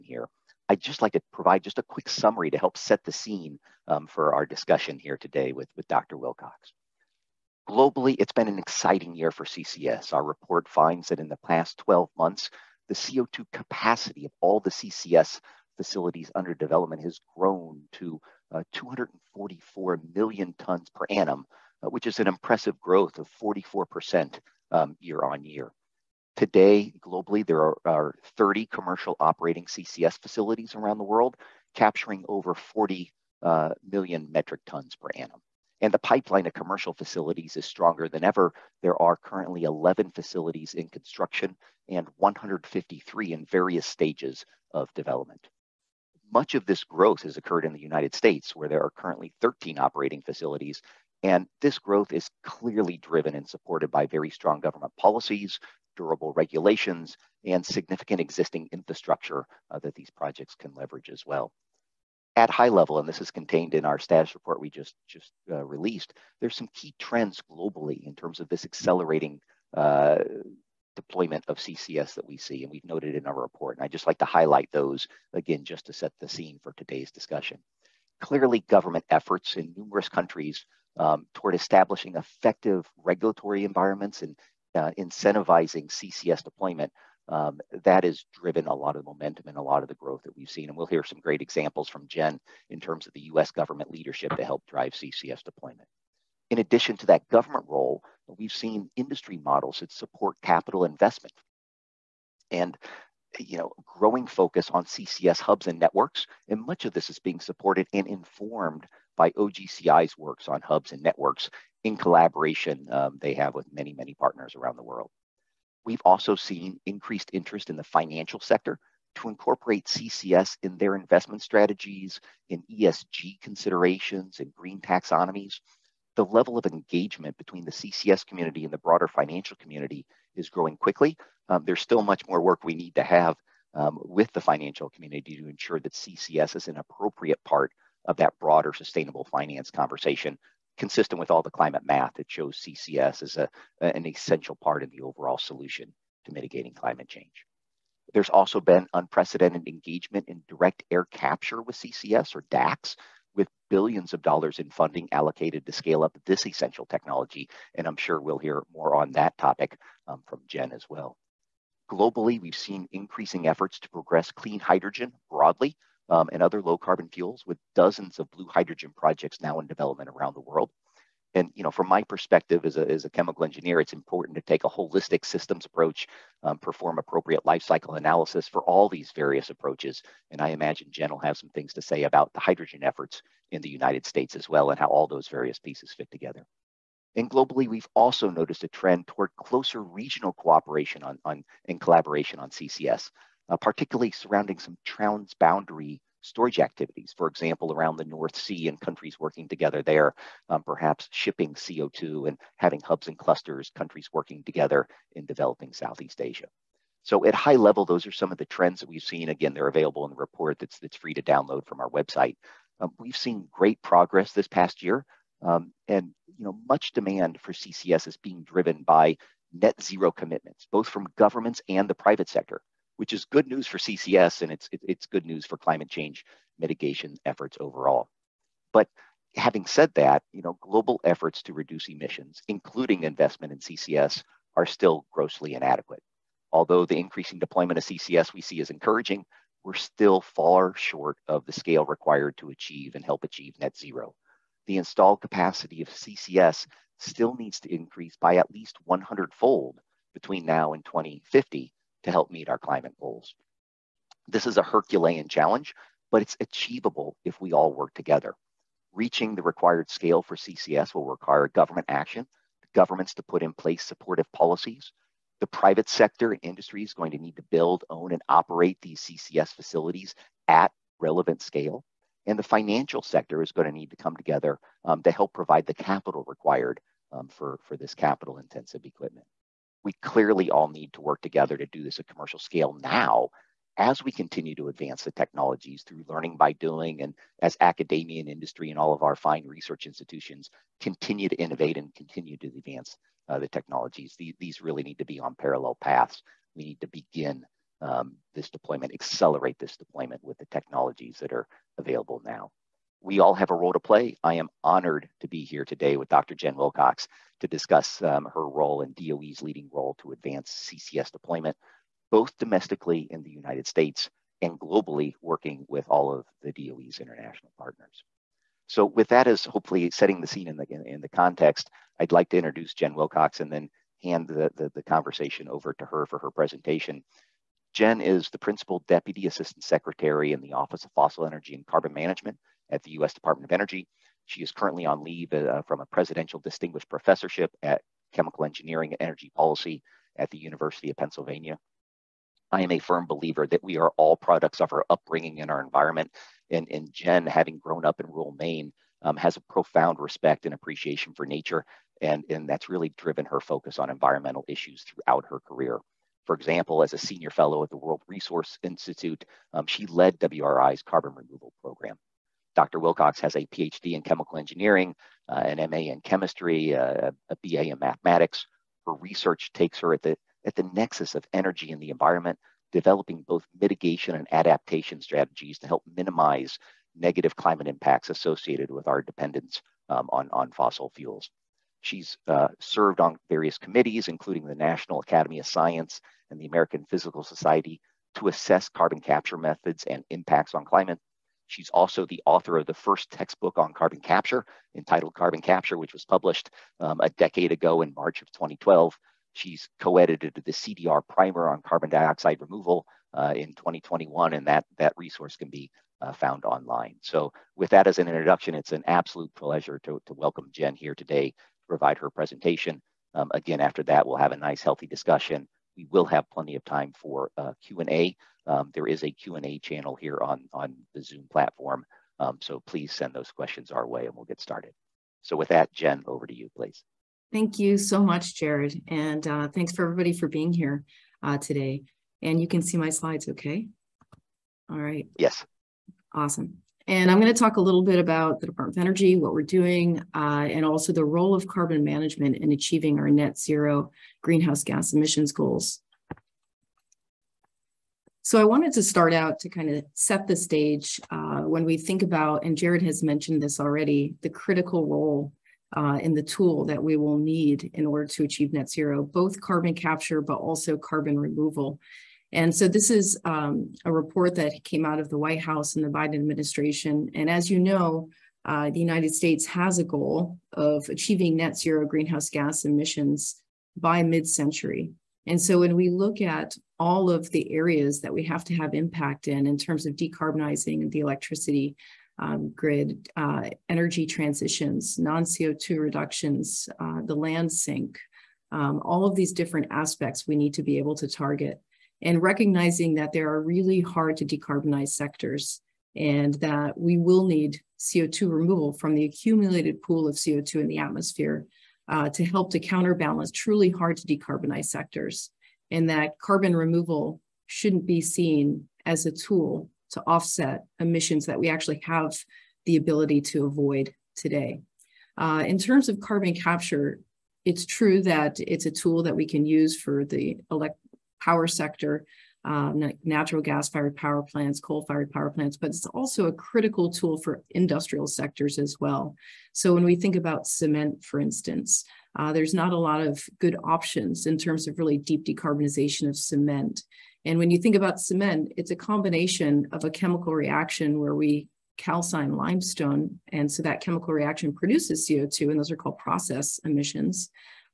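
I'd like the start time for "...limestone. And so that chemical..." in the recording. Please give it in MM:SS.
09:02.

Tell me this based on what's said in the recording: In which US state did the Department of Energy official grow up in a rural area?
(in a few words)
Maine.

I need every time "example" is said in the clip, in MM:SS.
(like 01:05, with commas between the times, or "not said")
01:31, 03:17, 05:56.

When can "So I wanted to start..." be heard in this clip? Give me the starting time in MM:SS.
07:28.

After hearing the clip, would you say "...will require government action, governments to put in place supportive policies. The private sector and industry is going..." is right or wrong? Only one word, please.
right.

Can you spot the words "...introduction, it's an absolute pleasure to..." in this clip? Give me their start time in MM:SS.
06:48.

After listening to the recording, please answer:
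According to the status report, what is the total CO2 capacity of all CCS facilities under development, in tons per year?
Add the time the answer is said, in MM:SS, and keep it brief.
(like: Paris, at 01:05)
244 million, at 00:18.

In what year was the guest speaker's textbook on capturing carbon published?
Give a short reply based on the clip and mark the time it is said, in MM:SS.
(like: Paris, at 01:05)
2012, at 06:38.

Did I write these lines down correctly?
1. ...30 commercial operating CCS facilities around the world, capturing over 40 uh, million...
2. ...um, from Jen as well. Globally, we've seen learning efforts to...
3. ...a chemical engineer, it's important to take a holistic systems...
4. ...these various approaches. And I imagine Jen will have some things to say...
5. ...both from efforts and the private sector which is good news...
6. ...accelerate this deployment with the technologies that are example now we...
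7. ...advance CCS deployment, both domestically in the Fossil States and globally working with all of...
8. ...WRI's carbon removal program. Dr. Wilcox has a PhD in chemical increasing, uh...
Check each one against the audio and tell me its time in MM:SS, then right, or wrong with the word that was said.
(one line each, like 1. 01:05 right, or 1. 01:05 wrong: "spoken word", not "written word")
1. 00:28 right
2. 02:40 wrong: "increasing", not "learning"
3. 02:53 right
4. 02:58 right
5. 03:40 wrong: "governments", not "efforts"
6. 04:58 wrong: "available", not "example"
7. 05:10 wrong: "United", not "Fossil"
8. 06:00 wrong: "engineering", not "increasing".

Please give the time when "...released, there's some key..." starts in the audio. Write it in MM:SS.
01:05.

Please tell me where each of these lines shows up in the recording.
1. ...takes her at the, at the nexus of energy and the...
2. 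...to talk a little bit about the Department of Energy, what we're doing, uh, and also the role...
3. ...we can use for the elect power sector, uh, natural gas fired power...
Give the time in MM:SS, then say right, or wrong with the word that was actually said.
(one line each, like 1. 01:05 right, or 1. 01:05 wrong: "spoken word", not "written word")
1. 06:09 right
2. 07:17 right
3. 08:39 right.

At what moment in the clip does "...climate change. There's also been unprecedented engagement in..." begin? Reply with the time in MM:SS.
02:26.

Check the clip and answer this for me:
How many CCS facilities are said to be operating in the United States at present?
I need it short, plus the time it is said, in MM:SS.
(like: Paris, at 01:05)
13, at 00:49.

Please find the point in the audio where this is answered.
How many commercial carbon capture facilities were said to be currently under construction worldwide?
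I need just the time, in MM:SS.
00:39.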